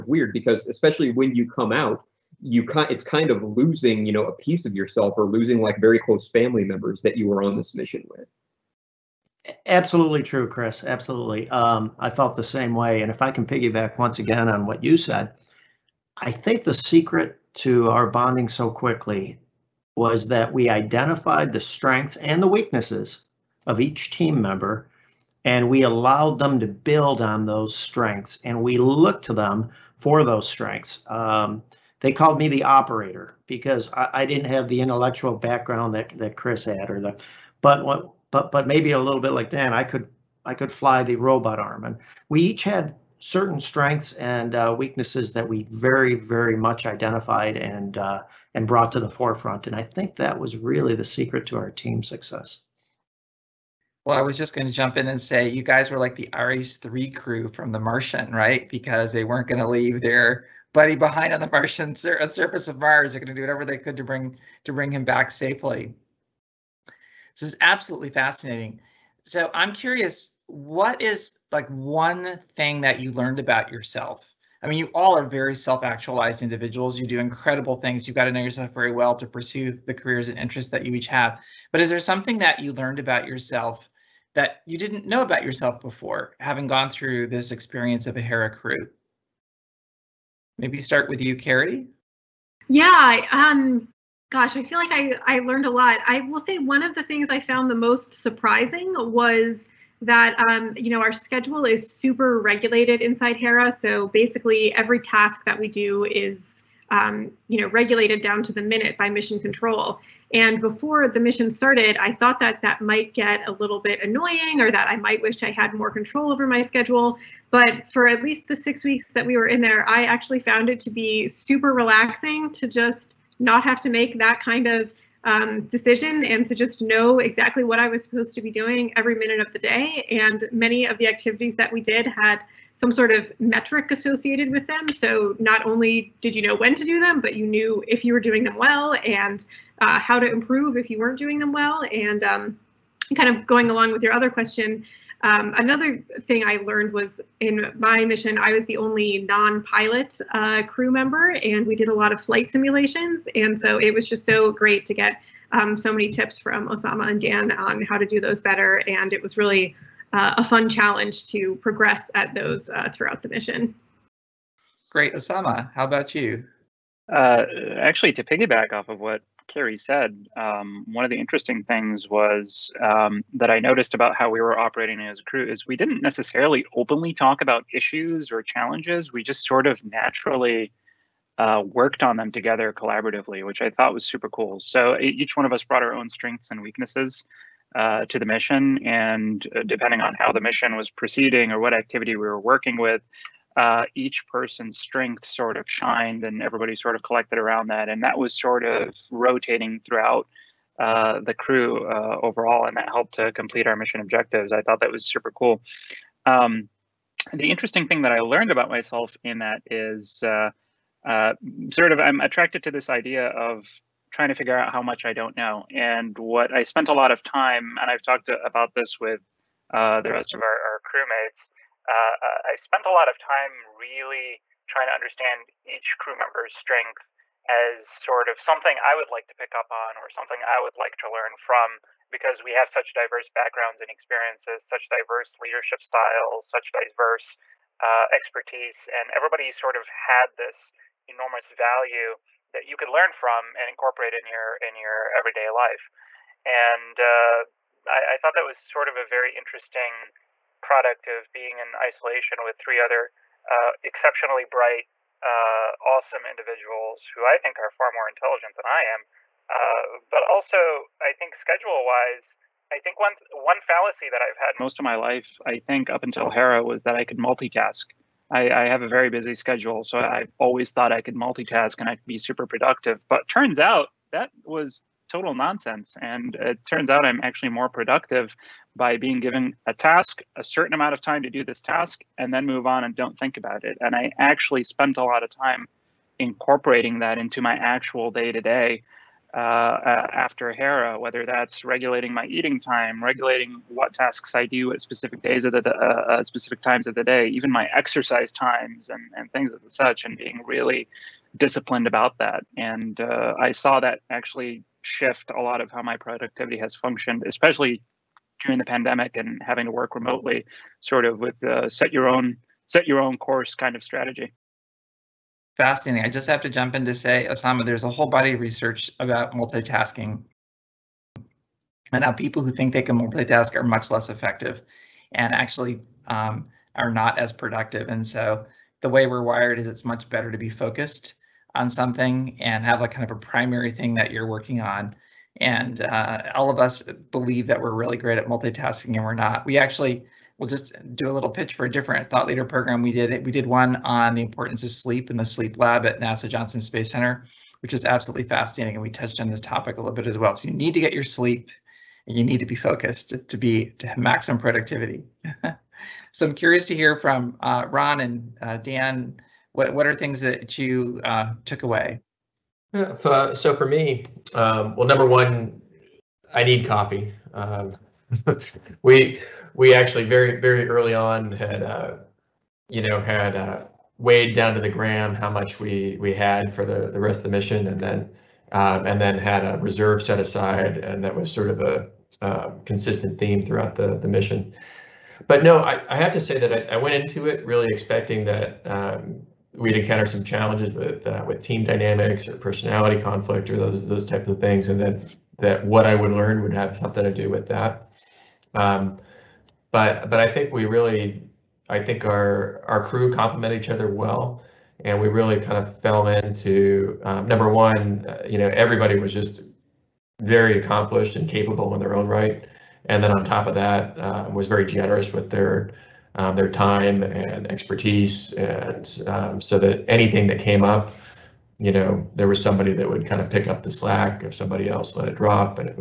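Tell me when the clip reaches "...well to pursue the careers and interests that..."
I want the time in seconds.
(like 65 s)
78 s.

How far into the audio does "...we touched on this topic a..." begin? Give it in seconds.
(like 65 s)
348 s.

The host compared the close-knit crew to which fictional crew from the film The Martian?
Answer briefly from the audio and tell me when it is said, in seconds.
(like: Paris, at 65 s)
Ares 3, at 56 s.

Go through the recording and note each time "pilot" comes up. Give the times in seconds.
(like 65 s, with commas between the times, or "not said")
149 s.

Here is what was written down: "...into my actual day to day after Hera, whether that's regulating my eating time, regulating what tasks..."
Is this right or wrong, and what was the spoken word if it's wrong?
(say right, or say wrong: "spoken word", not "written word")
right.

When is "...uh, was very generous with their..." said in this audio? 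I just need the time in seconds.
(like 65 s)
413 s.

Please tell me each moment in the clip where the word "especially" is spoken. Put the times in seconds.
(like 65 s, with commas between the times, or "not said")
0 s, 307 s.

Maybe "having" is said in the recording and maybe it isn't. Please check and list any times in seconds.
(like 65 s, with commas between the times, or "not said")
86 s, 309 s.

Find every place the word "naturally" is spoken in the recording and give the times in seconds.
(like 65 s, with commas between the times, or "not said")
179 s.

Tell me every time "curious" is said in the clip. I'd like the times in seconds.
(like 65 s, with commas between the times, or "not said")
69 s, 356 s.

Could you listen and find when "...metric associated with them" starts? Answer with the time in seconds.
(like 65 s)
133 s.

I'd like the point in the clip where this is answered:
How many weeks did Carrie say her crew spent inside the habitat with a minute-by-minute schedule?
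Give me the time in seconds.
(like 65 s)
118 s.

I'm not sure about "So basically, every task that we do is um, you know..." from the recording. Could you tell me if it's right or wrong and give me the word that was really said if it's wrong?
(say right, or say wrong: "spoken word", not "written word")
right.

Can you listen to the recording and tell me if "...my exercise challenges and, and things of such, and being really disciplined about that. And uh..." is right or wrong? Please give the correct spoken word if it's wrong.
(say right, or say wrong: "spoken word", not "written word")
wrong: "times", not "challenges".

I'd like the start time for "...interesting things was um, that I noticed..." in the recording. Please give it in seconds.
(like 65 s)
171 s.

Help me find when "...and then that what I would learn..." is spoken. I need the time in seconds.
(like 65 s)
394 s.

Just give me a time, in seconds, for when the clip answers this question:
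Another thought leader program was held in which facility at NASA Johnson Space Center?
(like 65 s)
345 s.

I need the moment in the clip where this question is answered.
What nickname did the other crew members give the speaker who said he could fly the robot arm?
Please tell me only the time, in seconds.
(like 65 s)
32 s.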